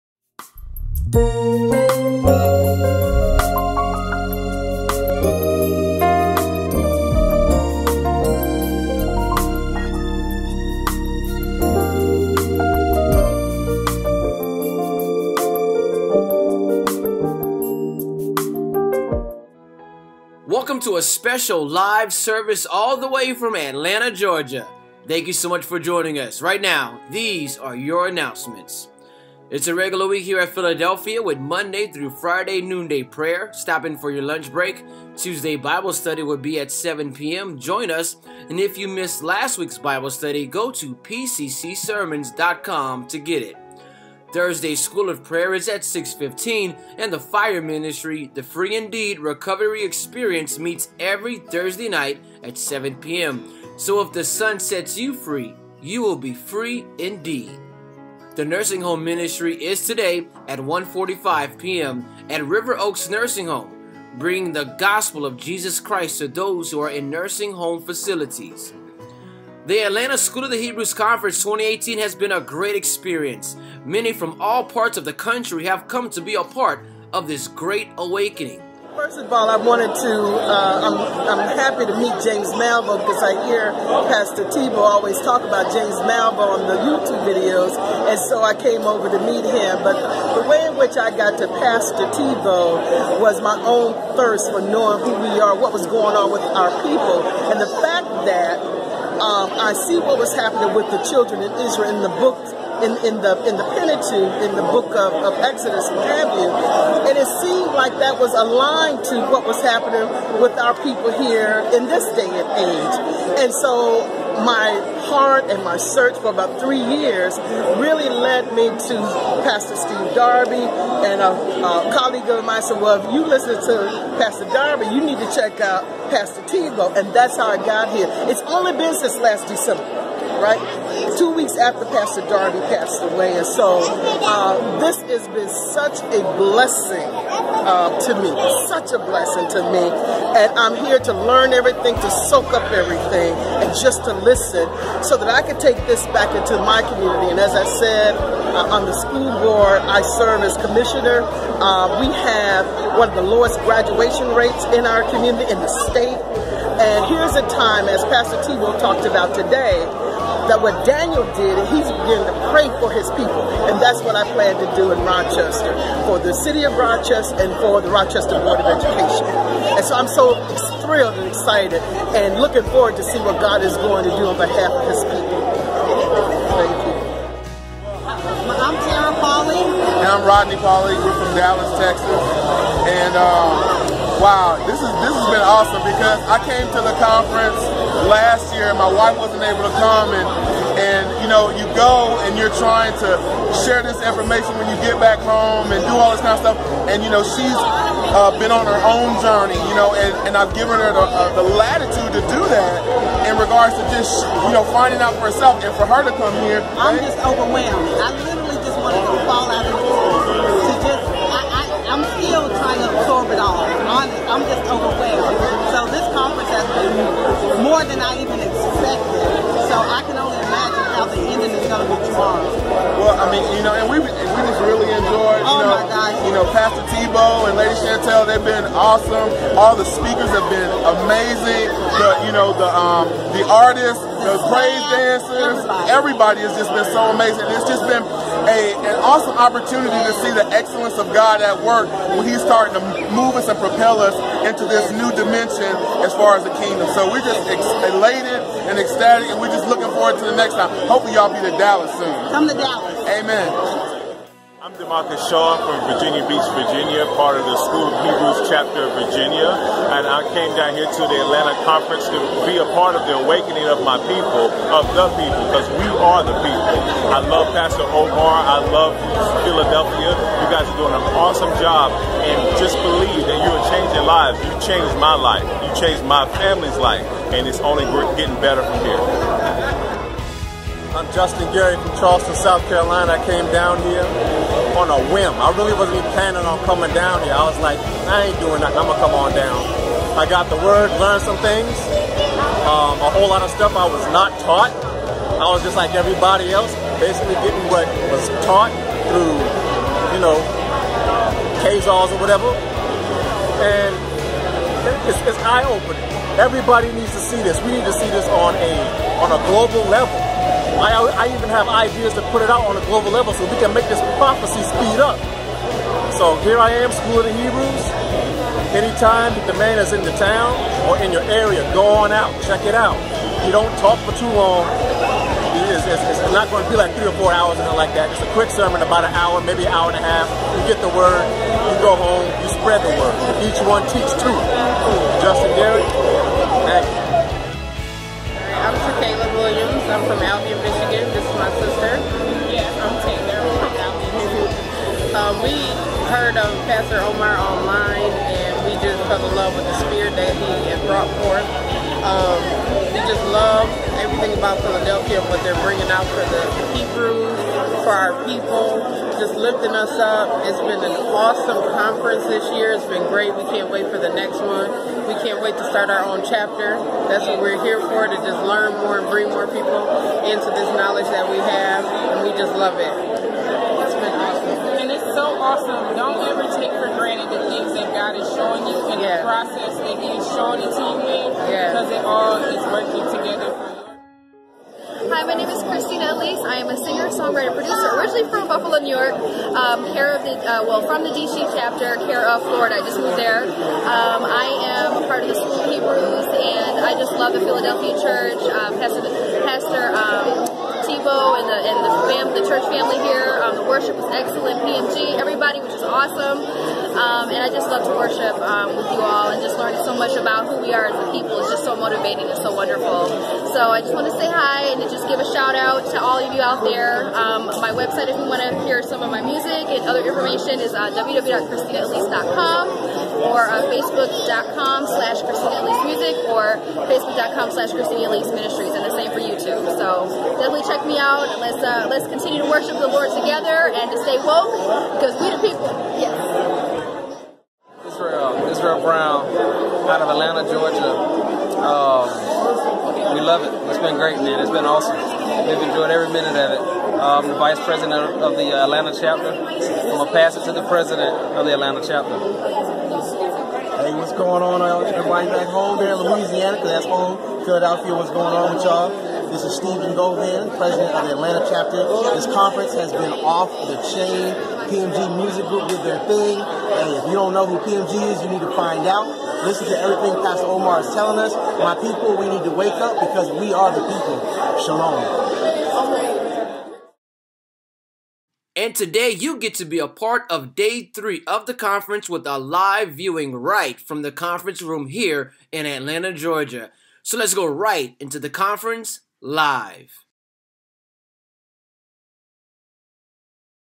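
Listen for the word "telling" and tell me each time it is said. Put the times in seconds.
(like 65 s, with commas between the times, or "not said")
470 s.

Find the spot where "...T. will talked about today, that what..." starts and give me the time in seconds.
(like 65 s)
158 s.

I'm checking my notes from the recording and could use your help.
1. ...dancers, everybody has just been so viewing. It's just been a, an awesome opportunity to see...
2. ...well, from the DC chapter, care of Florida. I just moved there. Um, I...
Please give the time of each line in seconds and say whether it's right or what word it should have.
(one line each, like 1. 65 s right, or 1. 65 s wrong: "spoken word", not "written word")
1. 234 s wrong: "amazing", not "viewing"
2. 390 s right.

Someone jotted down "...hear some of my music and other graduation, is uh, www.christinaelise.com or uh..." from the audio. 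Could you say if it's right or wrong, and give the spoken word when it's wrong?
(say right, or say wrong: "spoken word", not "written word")
wrong: "information", not "graduation".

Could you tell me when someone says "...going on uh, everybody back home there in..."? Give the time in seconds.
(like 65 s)
454 s.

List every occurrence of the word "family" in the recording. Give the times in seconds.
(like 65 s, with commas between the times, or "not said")
276 s, 402 s.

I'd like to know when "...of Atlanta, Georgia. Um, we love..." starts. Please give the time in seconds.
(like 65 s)
440 s.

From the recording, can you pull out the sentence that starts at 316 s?
So here I am, School of the Hebrews.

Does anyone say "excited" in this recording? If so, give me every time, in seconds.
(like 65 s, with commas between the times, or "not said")
171 s.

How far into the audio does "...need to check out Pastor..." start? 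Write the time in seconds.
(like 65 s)
125 s.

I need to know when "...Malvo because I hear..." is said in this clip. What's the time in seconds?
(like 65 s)
82 s.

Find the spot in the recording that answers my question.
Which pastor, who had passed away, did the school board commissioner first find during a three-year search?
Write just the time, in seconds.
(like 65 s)
119 s.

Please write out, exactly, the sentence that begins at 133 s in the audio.
And so uh, this has been such a blessing uh, to me, such a blessing to me.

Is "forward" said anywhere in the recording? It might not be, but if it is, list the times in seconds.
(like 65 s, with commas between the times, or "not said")
172 s, 249 s.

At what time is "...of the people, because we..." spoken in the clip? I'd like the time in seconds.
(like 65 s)
264 s.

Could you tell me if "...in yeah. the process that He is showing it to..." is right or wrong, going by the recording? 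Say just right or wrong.
right.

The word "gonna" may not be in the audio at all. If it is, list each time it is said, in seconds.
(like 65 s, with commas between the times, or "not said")
288 s, 449 s.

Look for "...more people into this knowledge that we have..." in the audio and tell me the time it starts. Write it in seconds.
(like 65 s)
369 s.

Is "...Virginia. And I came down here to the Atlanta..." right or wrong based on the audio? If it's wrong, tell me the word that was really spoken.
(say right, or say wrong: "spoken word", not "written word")
right.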